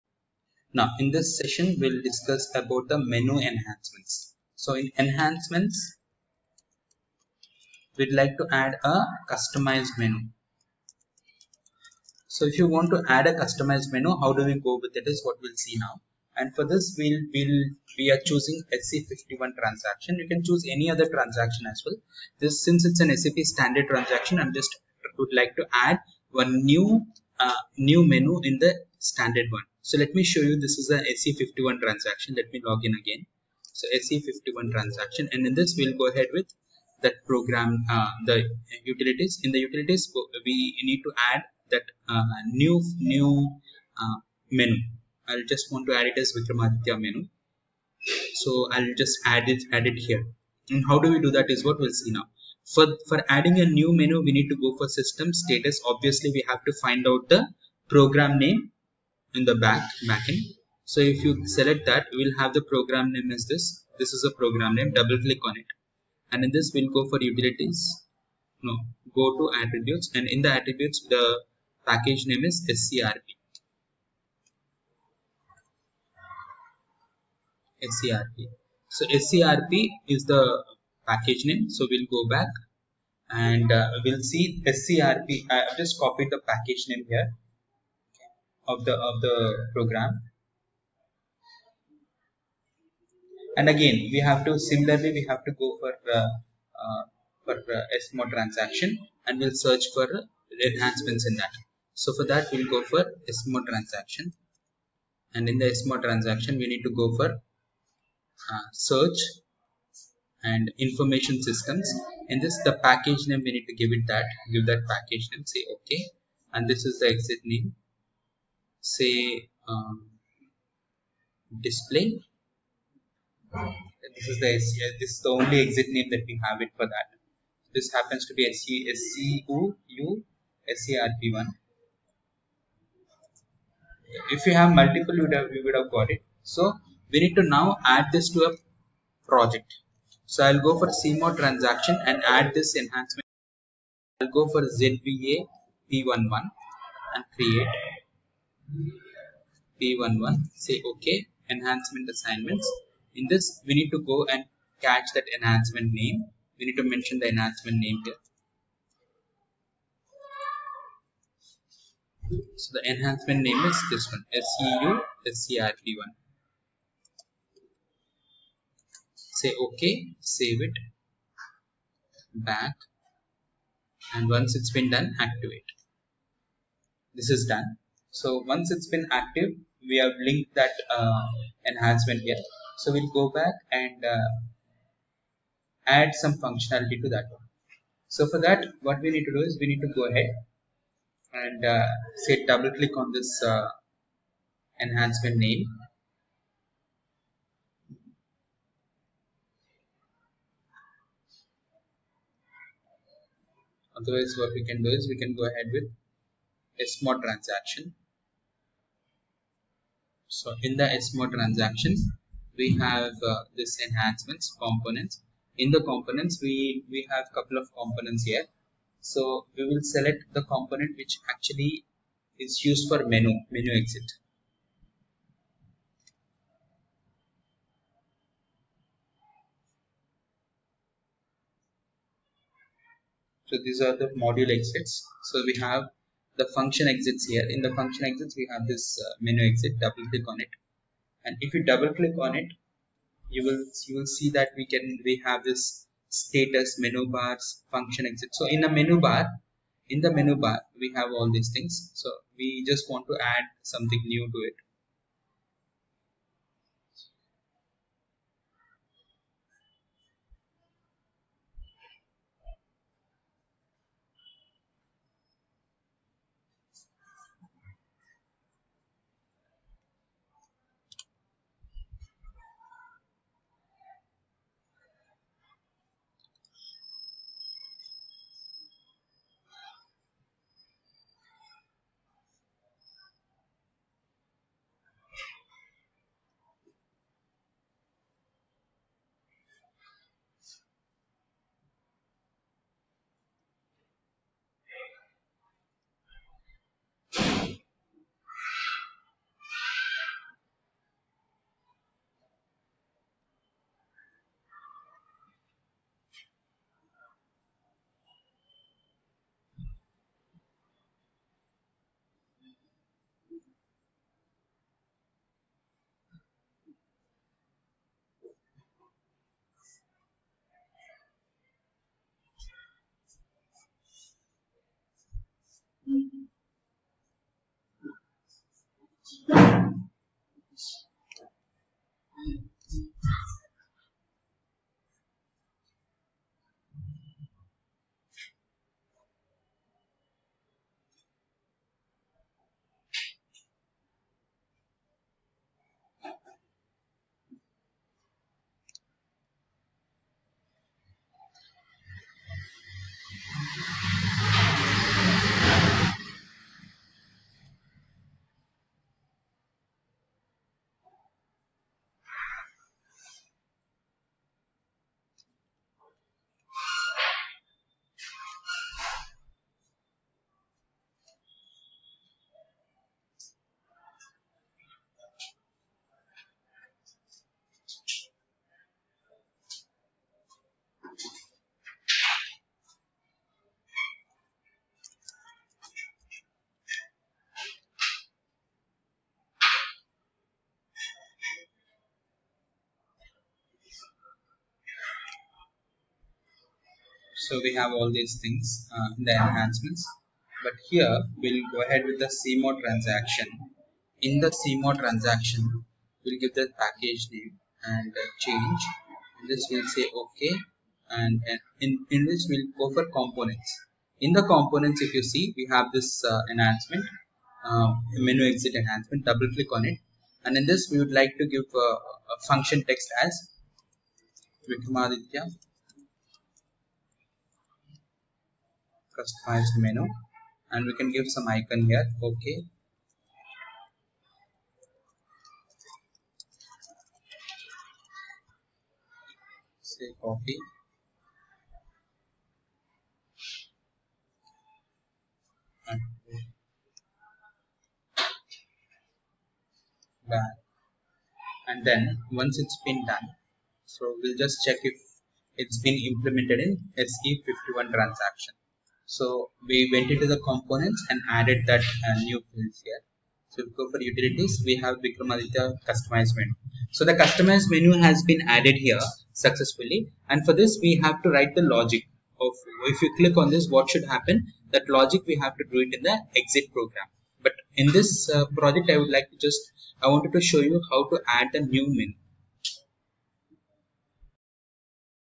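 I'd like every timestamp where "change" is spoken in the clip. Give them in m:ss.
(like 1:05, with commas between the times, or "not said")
6:48.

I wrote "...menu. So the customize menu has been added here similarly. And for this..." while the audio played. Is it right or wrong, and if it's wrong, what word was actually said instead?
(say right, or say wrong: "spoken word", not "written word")
wrong: "successfully", not "similarly".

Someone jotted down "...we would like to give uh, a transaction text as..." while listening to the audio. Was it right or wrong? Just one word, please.
wrong.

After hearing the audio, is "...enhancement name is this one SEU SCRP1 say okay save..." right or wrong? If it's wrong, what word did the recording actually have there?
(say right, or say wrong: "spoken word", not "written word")
right.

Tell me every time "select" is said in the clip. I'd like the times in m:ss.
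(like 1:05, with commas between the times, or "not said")
1:01, 3:39.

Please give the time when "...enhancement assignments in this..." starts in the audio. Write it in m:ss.
2:31.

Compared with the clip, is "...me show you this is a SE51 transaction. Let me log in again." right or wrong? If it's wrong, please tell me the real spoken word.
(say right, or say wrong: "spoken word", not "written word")
right.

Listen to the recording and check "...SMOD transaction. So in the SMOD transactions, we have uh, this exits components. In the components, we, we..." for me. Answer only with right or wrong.
wrong.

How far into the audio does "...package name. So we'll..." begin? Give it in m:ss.
1:21.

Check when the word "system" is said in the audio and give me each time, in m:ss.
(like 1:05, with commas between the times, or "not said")
0:54, 1:51.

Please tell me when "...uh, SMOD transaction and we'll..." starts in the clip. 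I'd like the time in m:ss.
1:37.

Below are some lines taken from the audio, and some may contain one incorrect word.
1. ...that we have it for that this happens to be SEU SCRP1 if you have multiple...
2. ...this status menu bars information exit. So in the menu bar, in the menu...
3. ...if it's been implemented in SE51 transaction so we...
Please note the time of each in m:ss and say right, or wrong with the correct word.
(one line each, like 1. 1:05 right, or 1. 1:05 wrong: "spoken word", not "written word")
1. 2:06 right
2. 4:05 wrong: "function", not "information"
3. 7:34 right.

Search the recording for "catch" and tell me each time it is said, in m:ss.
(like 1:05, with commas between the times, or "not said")
2:34.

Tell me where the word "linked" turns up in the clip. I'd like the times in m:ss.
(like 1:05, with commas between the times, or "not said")
3:00.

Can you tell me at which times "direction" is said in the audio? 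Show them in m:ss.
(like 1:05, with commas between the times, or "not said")
not said.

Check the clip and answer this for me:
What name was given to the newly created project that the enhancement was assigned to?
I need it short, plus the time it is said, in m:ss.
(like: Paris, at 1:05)
ZVA P11, at 2:24.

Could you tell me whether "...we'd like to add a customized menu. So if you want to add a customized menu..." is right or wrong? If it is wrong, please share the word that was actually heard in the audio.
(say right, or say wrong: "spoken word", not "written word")
right.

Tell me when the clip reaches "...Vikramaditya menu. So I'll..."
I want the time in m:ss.
0:46.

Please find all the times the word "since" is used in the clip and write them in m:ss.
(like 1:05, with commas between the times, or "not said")
0:22.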